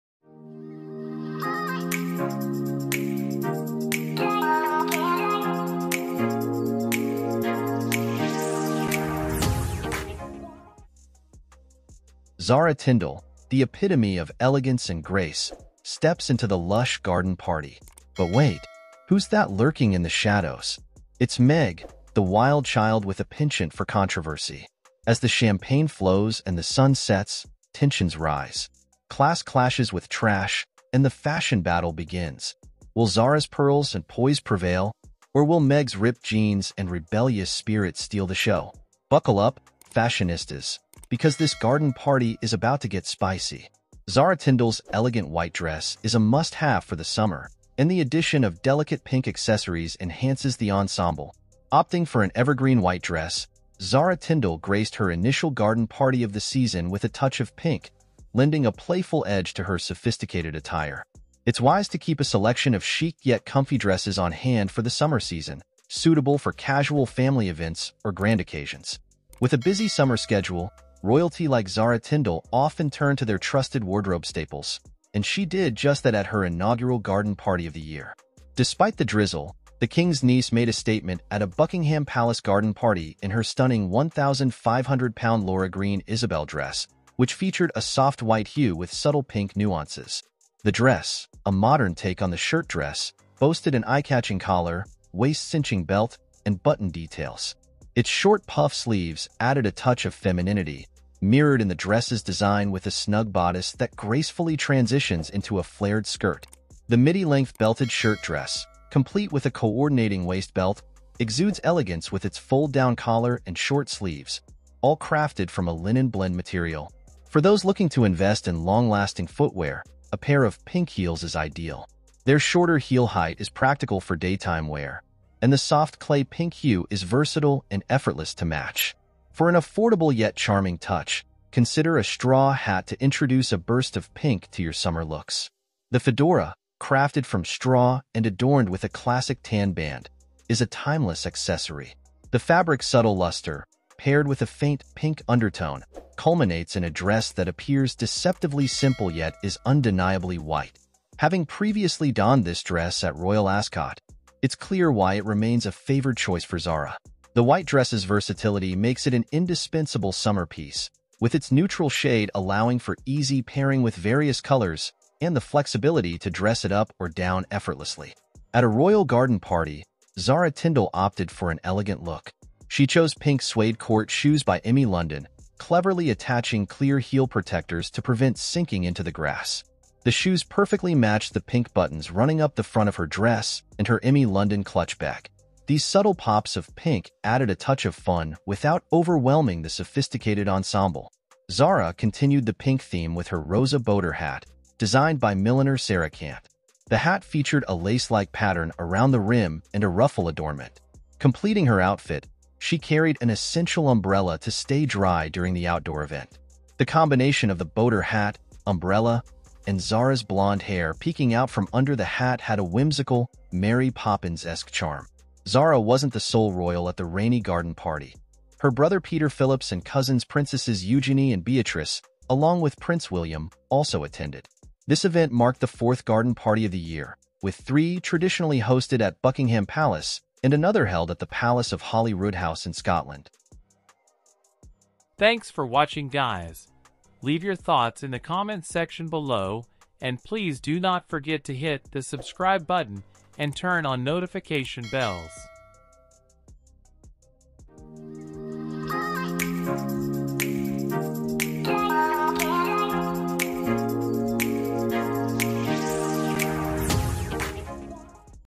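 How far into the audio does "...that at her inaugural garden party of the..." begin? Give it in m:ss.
1:16.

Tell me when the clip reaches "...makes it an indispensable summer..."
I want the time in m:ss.
2:38.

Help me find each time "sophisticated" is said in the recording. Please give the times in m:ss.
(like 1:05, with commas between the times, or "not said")
0:59, 3:09.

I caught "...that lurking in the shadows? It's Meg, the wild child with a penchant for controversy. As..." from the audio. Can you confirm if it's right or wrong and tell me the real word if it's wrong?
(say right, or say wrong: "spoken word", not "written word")
right.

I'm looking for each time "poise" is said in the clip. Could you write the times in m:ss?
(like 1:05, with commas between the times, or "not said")
0:34.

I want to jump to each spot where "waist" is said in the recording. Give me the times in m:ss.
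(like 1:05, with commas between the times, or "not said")
1:35, 1:50.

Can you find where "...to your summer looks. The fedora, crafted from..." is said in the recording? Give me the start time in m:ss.
2:14.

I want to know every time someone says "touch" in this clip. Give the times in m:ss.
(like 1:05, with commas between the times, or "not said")
0:57, 1:39, 2:10, 3:07.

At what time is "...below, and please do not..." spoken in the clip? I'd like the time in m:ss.
3:59.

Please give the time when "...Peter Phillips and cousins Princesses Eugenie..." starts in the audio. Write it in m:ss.
3:39.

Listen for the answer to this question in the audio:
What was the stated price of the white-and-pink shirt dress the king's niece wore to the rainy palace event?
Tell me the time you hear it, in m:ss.
1:23.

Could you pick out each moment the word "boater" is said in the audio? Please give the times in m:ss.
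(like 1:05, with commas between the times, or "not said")
3:13, 3:27.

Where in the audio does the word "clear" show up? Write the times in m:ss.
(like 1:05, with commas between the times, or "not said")
2:34, 2:56.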